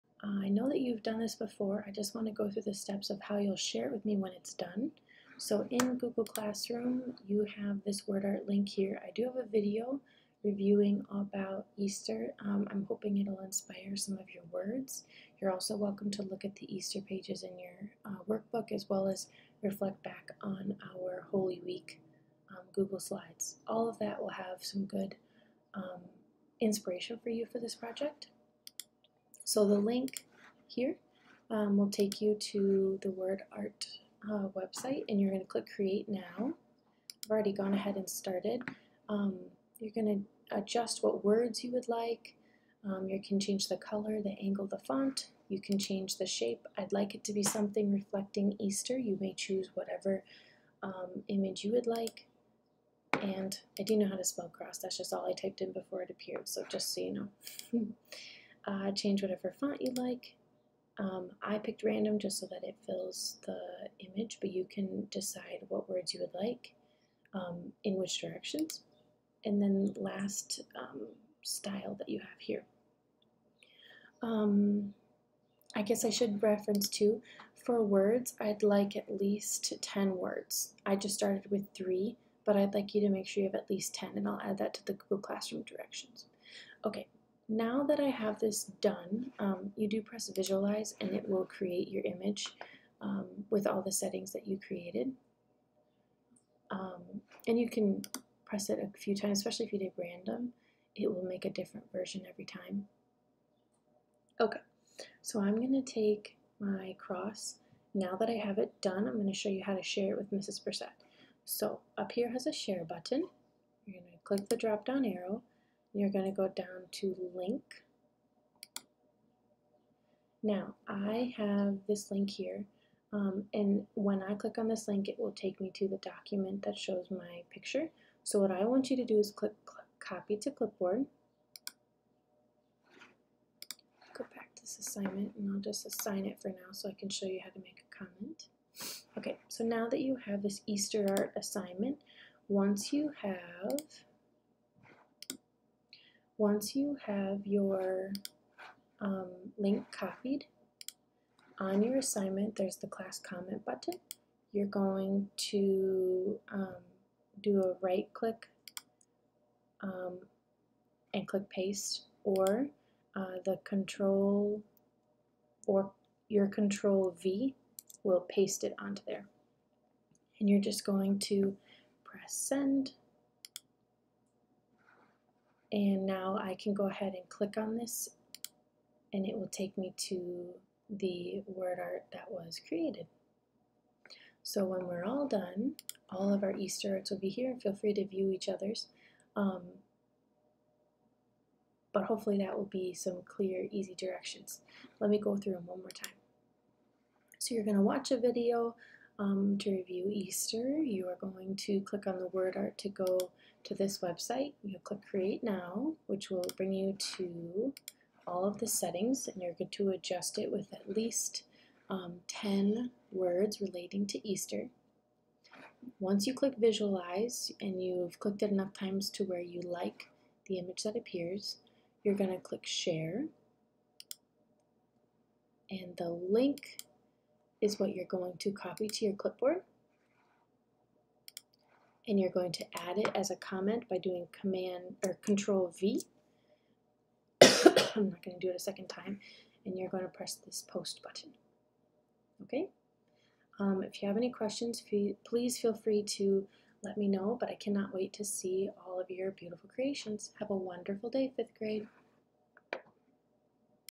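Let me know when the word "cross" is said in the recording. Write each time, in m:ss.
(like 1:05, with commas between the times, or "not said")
0:54, 1:46.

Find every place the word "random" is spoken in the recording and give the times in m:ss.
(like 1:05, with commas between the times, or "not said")
1:01, 1:39.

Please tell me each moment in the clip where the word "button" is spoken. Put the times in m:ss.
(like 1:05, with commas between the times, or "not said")
1:52, 2:33, 4:01.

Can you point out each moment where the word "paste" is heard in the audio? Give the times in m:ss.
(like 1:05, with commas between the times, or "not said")
2:41, 2:48.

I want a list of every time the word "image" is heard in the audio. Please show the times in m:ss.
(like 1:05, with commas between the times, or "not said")
0:51, 1:03, 1:32, 3:40.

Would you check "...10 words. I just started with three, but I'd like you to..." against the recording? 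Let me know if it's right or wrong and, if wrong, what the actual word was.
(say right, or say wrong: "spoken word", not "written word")
right.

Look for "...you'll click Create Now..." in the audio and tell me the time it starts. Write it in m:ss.
3:24.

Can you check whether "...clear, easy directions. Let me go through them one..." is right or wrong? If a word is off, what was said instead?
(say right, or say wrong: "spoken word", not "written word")
right.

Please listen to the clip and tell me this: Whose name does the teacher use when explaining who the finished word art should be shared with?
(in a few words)
Mrs. Brissette.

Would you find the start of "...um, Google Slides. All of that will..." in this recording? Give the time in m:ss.
0:22.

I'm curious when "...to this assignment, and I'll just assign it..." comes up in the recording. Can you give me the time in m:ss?
2:14.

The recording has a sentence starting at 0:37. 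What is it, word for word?
I've already gone ahead and started.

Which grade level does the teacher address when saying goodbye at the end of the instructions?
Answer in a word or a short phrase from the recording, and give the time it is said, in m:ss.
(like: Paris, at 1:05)
Fifth grade, at 4:11.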